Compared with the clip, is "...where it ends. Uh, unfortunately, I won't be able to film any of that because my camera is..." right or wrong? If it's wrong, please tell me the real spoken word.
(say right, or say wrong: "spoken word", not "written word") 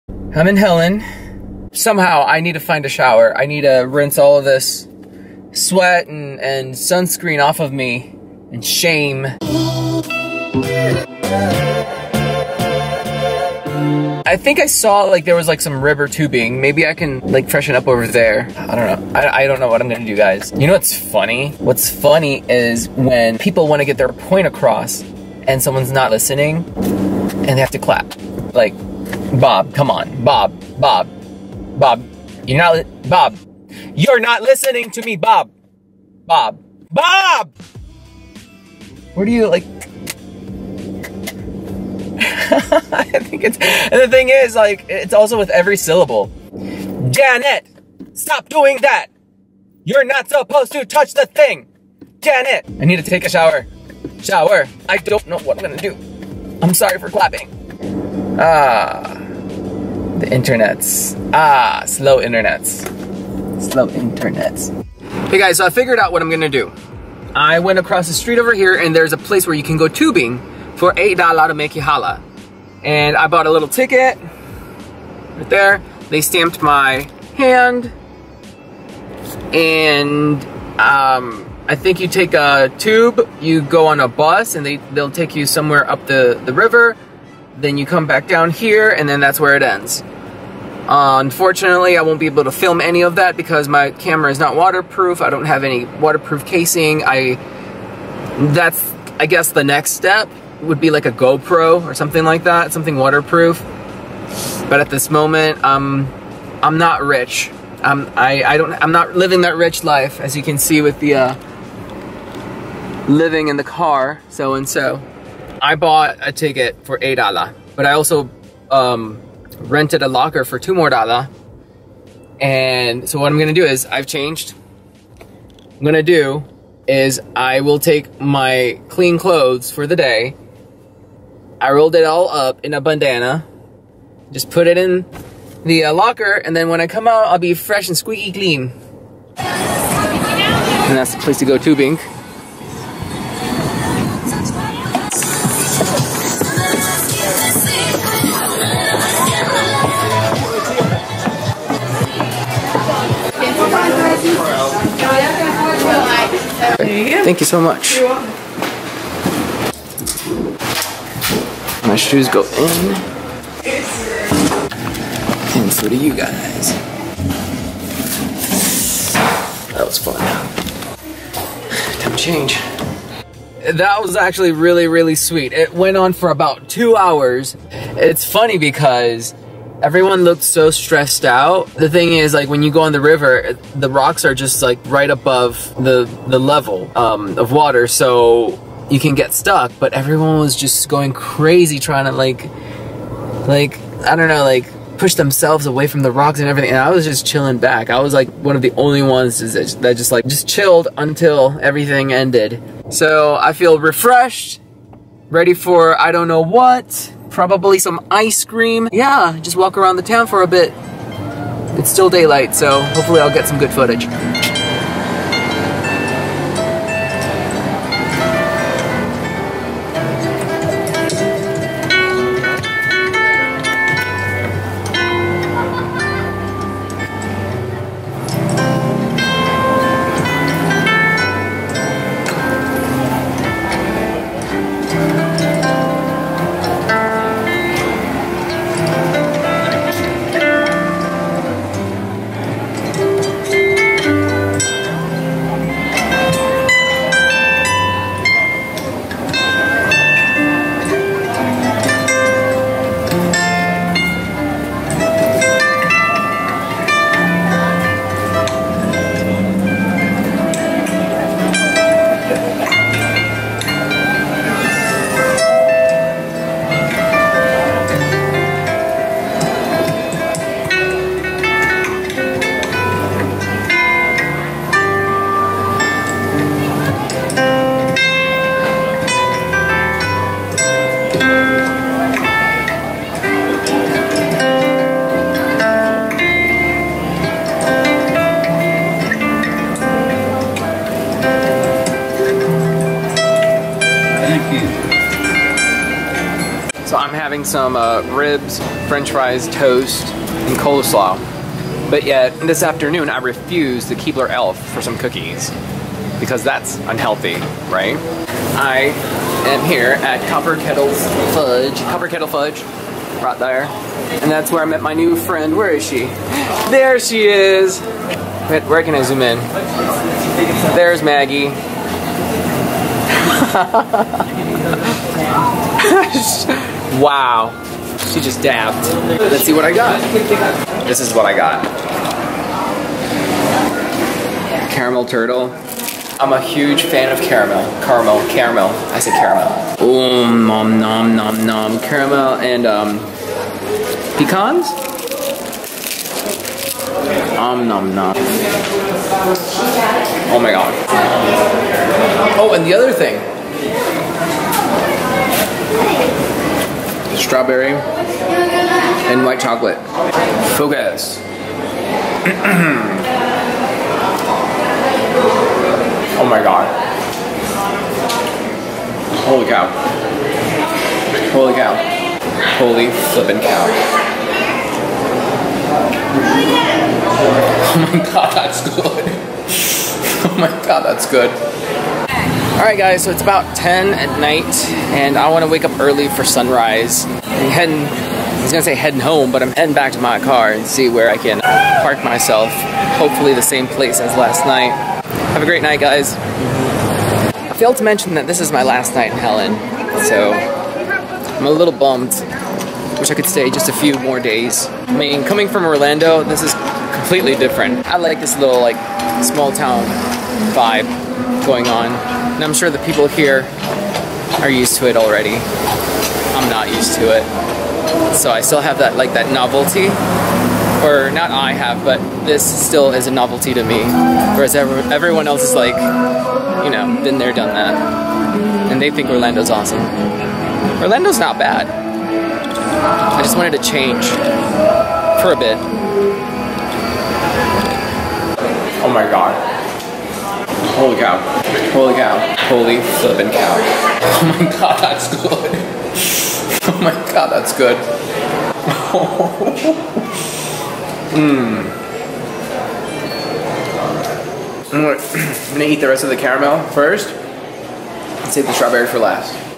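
right.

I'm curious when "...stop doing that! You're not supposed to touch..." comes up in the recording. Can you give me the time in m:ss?
0:48.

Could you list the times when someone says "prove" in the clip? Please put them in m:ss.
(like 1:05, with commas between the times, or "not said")
not said.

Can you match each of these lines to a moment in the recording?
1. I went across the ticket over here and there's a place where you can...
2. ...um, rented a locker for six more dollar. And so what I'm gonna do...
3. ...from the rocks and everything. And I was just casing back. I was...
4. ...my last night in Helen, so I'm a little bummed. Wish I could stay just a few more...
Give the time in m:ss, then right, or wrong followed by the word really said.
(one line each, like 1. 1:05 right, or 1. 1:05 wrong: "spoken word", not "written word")
1. 1:07 wrong: "street", not "ticket"
2. 1:58 wrong: "two", not "six"
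3. 3:15 wrong: "chilling", not "casing"
4. 6:38 right.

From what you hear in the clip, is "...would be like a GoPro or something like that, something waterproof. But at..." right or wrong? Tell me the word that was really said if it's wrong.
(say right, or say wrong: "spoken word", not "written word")
right.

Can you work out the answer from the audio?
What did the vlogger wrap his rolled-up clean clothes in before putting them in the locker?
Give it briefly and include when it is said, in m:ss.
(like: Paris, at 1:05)
A bandana, at 2:12.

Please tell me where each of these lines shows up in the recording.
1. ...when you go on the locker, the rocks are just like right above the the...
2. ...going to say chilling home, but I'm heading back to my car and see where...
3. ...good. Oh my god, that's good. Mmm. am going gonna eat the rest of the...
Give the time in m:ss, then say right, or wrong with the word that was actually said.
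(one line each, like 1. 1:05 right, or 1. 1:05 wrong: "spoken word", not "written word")
1. 3:02 wrong: "river", not "locker"
2. 6:28 wrong: "heading", not "chilling"
3. 7:27 right.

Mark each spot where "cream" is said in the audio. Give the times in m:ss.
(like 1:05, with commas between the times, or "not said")
3:28.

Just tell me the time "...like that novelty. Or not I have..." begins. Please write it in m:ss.
6:58.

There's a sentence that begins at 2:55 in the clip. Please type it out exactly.
It went on for about two hours.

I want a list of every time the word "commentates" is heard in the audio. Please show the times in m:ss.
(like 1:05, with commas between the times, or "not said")
not said.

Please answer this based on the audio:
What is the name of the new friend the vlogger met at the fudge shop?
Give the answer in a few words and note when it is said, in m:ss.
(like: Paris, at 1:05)
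Maggie, at 5:21.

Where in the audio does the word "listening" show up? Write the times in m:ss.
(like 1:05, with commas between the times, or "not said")
0:26, 0:34.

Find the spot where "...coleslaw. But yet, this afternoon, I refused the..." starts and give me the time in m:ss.
5:00.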